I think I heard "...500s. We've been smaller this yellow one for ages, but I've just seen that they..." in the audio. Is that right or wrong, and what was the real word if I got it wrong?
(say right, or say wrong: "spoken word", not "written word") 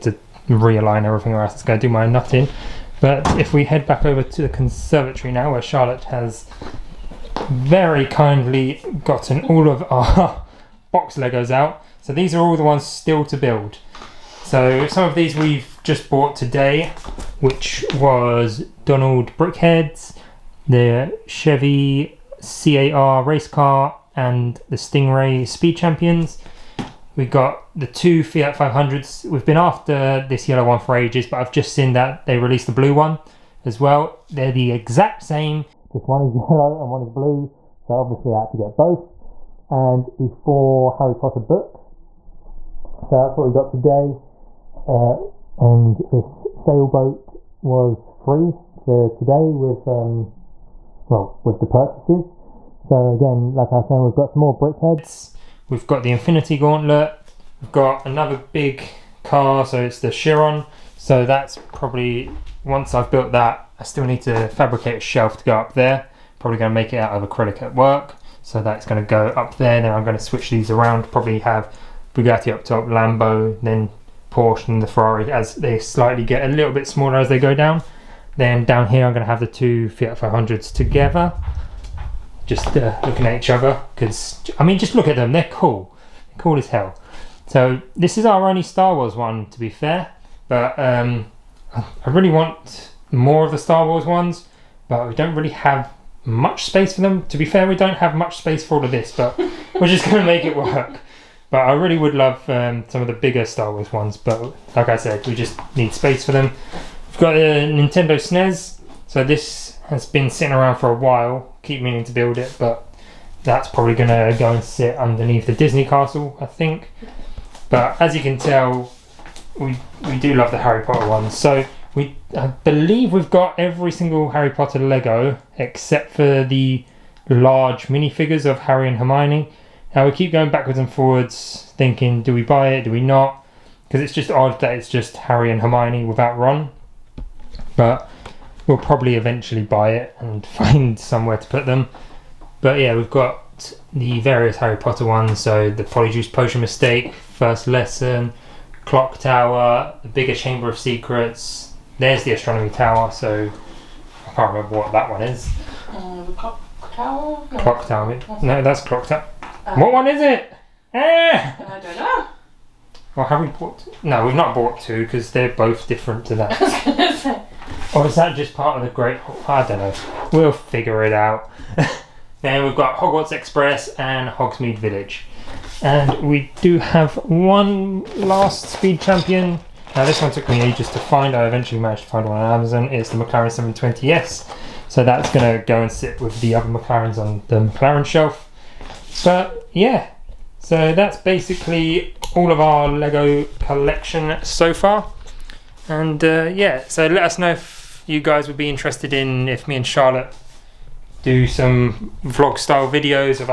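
wrong: "after", not "smaller".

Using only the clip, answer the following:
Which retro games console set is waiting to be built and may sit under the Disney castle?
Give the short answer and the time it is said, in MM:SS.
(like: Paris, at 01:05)
Nintendo SNES, at 01:47.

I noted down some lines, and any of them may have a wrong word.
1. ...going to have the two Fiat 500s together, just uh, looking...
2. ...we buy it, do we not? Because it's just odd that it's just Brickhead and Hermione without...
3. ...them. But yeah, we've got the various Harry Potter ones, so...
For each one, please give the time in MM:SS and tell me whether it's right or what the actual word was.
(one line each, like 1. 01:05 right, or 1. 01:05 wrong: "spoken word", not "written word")
1. 01:19 right
2. 02:12 wrong: "Harry", not "Brickhead"
3. 02:21 right.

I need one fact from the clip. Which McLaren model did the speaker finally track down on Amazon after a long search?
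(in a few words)
McLaren 720S.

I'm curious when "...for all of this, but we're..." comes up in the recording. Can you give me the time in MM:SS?
01:38.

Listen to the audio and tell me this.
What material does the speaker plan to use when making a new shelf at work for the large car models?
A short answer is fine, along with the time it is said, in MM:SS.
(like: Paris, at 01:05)
Acrylic, at 01:07.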